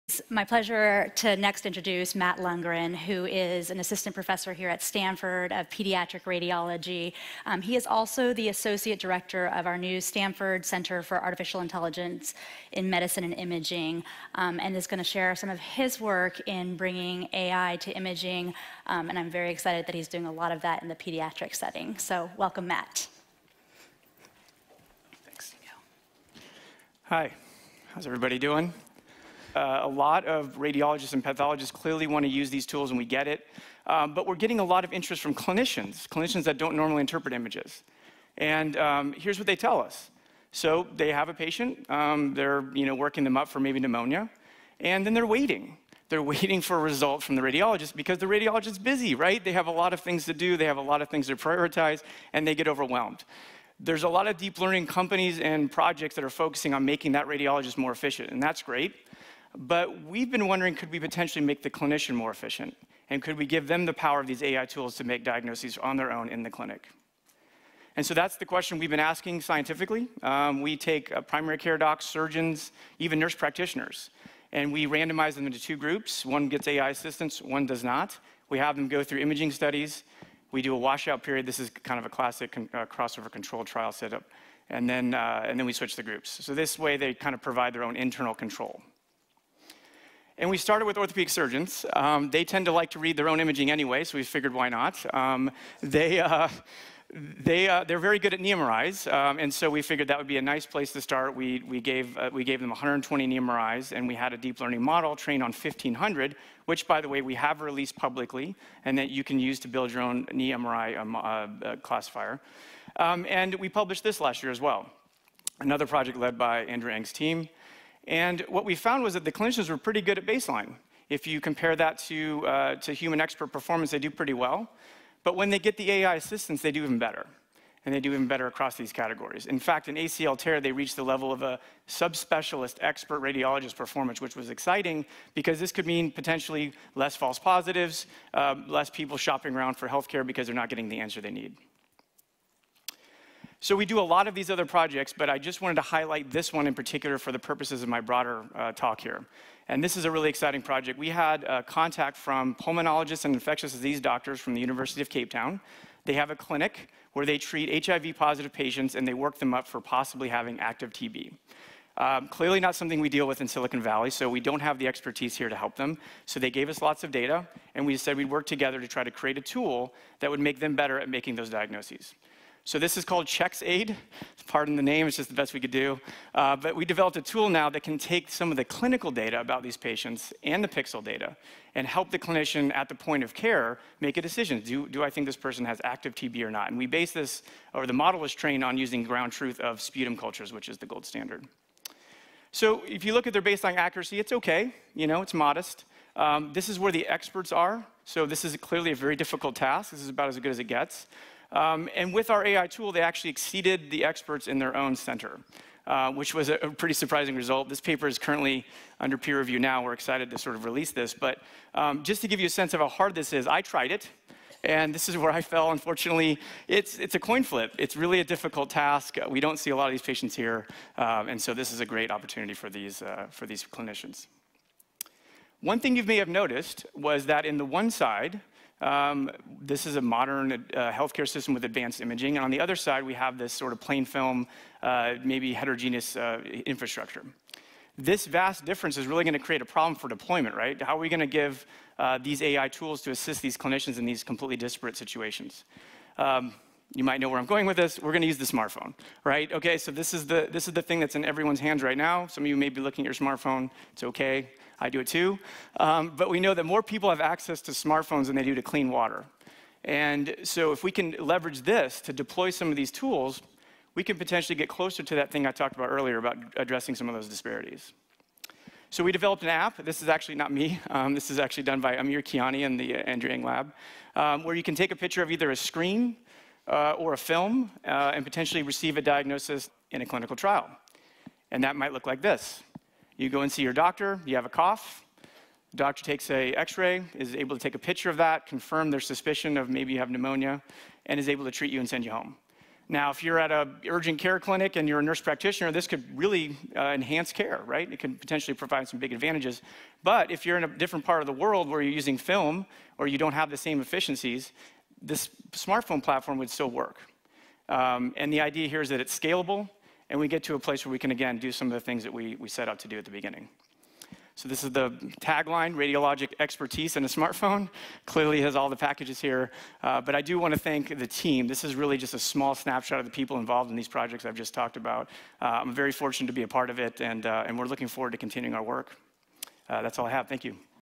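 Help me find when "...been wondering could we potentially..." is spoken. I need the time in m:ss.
1:00.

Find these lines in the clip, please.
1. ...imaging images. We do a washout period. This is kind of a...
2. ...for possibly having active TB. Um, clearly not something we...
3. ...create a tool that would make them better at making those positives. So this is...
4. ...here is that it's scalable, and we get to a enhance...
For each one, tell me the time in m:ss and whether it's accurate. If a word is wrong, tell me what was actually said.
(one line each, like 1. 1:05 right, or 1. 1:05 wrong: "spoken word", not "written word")
1. 1:19 wrong: "studies", not "images"
2. 2:39 right
3. 2:49 wrong: "diagnoses", not "positives"
4. 5:08 wrong: "place", not "enhance".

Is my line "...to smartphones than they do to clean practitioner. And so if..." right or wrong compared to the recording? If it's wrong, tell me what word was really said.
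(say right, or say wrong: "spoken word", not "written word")
wrong: "water", not "practitioner".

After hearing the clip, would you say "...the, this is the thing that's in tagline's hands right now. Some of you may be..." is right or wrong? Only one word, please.
wrong.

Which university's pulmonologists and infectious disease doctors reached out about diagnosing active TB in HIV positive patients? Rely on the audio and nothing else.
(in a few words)
University of Cape Town.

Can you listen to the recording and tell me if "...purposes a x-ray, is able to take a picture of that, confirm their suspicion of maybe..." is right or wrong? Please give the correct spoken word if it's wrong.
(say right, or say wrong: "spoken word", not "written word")
wrong: "takes", not "purposes".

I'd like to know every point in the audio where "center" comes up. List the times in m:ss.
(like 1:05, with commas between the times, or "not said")
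0:10, 3:24.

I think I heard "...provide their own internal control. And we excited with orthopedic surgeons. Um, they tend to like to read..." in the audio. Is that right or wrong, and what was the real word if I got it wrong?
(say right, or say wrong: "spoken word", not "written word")
wrong: "started", not "excited".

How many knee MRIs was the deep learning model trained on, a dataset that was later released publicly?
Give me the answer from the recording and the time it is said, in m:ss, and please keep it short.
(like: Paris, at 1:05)
1,500, at 1:45.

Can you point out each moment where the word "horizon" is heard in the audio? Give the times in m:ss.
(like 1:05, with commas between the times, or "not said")
not said.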